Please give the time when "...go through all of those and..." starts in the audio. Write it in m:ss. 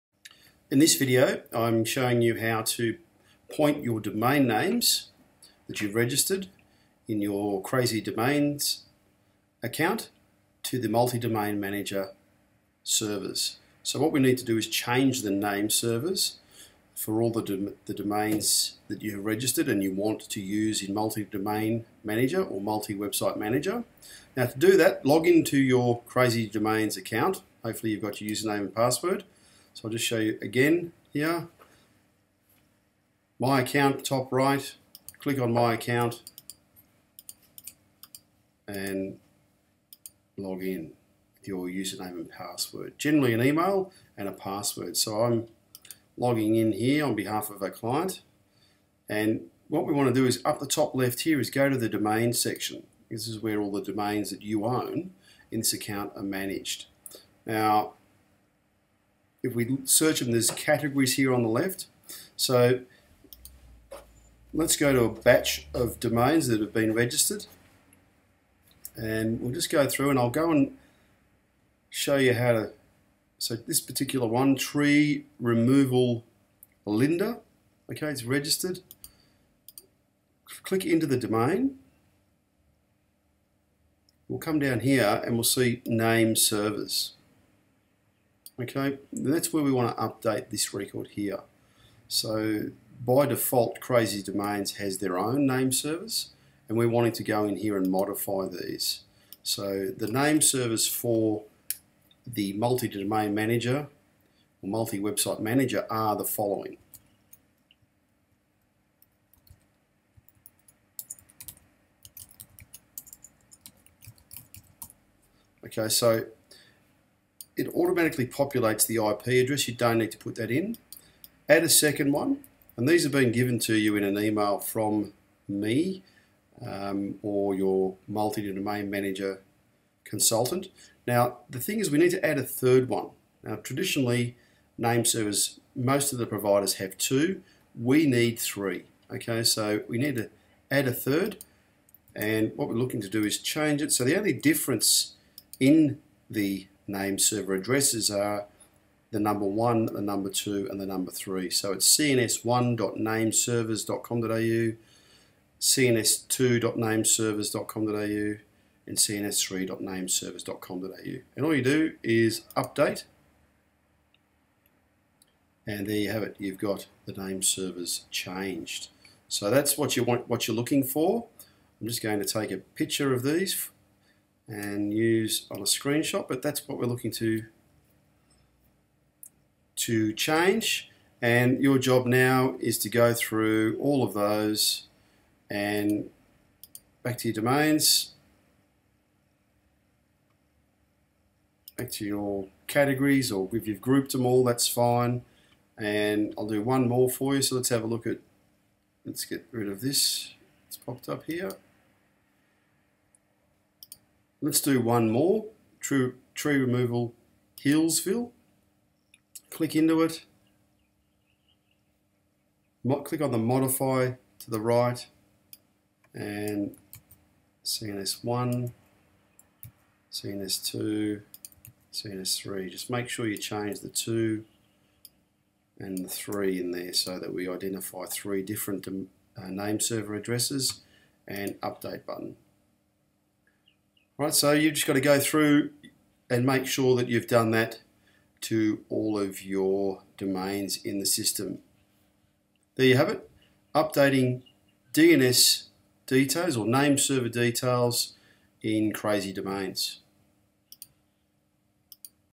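3:02.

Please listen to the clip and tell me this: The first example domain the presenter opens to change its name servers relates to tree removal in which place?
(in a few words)
Linda.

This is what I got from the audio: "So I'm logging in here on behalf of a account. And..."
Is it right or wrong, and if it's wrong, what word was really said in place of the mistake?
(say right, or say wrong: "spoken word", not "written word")
wrong: "client", not "account".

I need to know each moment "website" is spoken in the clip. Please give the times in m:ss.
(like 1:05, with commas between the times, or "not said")
0:22, 1:44.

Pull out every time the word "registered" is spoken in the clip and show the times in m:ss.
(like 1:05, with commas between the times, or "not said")
0:05, 0:19, 1:06, 1:18.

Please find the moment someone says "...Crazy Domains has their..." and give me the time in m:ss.
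1:33.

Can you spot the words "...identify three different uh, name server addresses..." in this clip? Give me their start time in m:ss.
3:47.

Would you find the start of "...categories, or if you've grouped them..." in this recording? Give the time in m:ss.
3:12.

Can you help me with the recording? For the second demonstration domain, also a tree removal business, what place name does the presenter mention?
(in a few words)
Hillsville.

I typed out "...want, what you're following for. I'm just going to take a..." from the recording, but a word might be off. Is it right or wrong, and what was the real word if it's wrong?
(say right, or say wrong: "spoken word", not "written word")
wrong: "looking", not "following".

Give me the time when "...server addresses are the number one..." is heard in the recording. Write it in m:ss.
2:27.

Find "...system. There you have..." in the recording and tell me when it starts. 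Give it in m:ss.
4:01.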